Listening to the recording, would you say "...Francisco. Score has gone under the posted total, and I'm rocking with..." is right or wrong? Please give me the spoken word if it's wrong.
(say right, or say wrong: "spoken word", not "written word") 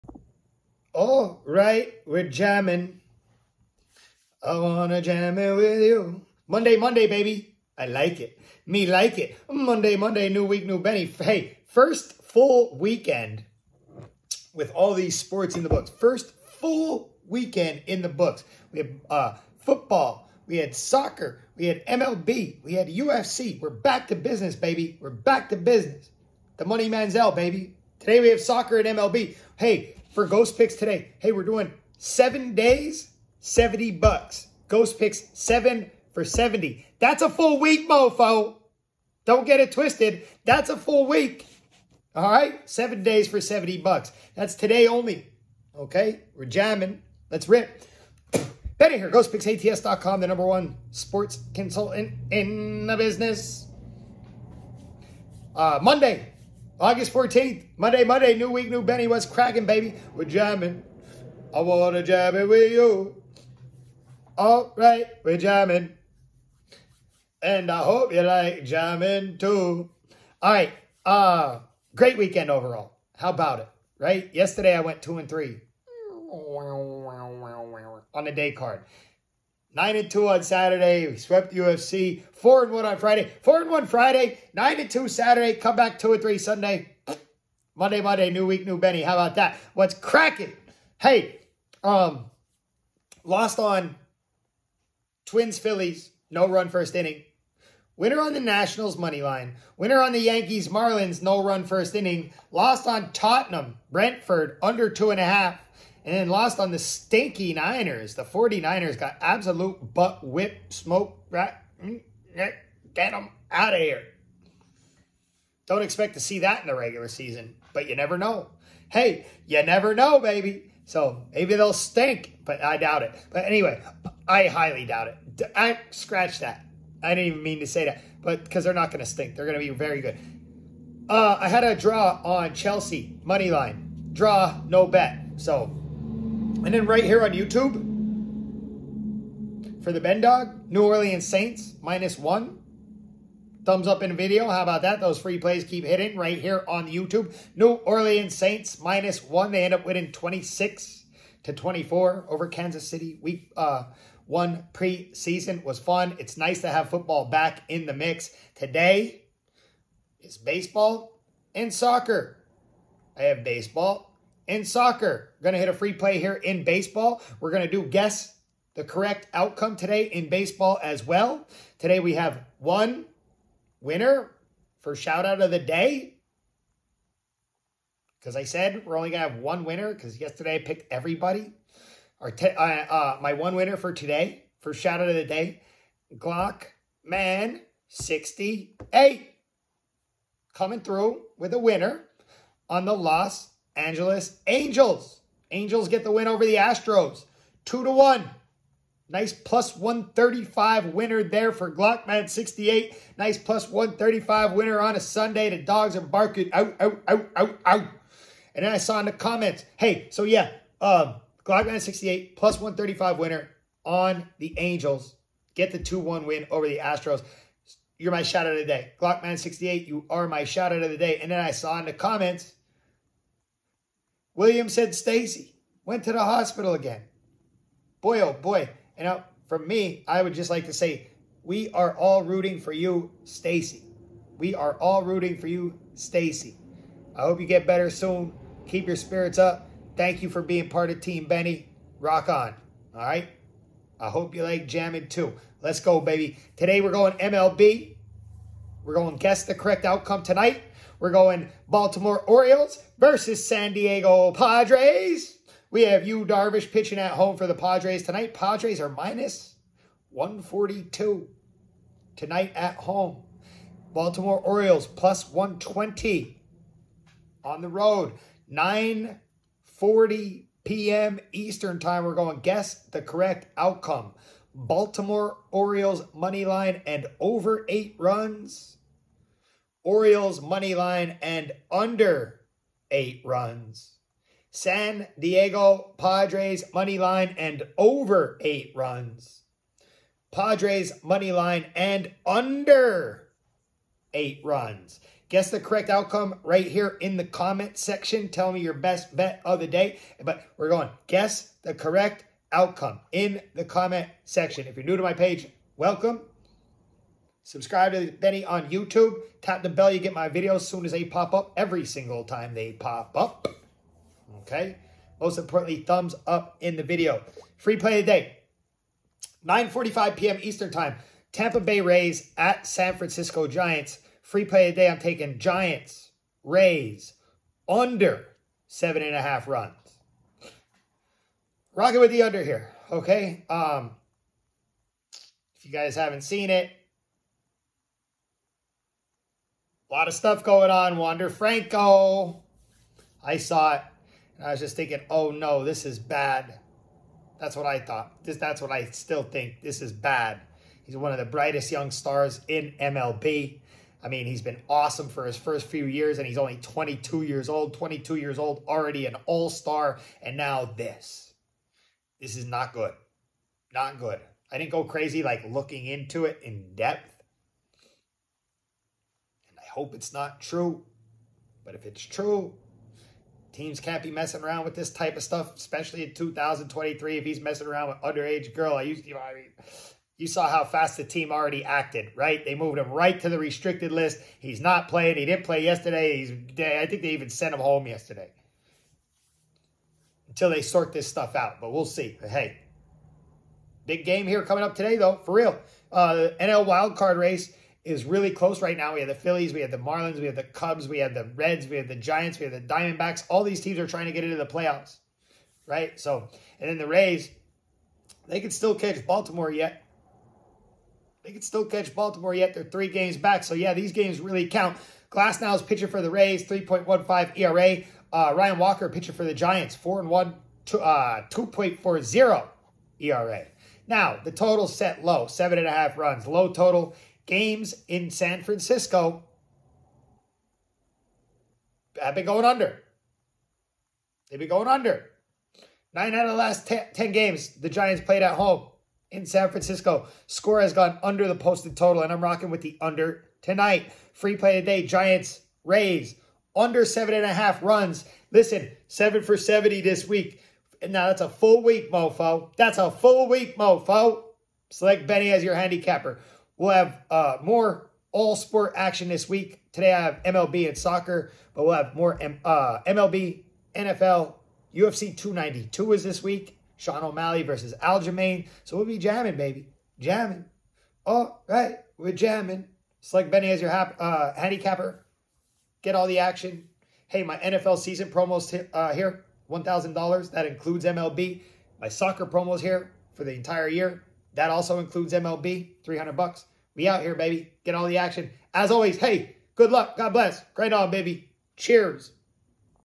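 right.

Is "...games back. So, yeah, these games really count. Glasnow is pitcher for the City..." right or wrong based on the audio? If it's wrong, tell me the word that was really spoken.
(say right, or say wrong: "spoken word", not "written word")
wrong: "Rays", not "City".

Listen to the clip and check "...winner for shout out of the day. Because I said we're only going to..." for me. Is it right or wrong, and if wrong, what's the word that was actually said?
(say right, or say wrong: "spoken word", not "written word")
right.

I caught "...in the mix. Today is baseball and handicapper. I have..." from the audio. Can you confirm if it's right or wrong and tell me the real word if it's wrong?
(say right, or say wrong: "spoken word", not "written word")
wrong: "soccer", not "handicapper".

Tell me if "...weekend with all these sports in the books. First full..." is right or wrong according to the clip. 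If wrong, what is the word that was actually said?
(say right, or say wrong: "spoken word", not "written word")
right.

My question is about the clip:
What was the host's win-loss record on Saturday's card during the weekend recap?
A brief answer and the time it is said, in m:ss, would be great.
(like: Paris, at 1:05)
9 and 2, at 1:19.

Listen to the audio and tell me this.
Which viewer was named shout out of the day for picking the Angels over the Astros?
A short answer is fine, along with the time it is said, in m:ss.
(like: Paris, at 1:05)
Glockman 68, at 3:06.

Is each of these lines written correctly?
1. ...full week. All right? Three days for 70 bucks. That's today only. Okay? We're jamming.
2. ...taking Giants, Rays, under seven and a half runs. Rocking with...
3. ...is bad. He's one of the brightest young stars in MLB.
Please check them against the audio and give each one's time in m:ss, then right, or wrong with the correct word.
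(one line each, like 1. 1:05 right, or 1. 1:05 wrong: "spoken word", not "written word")
1. 0:40 wrong: "Seven", not "Three"
2. 5:24 right
3. 5:49 right.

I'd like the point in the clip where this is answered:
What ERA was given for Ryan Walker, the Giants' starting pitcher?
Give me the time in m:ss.
7:01.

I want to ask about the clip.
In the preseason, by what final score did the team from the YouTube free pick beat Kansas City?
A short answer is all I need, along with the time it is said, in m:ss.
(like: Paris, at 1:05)
26 to 24, at 2:30.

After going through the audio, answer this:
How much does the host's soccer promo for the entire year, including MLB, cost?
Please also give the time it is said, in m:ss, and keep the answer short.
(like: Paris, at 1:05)
$300, at 8:05.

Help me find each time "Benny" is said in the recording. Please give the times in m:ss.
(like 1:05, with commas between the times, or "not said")
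0:10, 0:58, 1:28, 4:01, 5:08, 7:35, 7:53.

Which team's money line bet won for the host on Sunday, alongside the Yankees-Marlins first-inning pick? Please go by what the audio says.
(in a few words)
Nationals.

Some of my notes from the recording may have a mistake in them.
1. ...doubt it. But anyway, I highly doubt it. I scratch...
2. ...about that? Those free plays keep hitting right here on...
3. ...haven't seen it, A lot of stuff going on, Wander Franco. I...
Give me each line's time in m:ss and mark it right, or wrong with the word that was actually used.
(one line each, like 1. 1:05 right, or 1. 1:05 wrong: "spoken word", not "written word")
1. 2:02 right
2. 2:24 right
3. 5:35 right.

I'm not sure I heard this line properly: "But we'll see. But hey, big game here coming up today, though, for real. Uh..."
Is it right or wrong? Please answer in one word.
right.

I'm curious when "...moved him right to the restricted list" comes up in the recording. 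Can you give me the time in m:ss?
6:22.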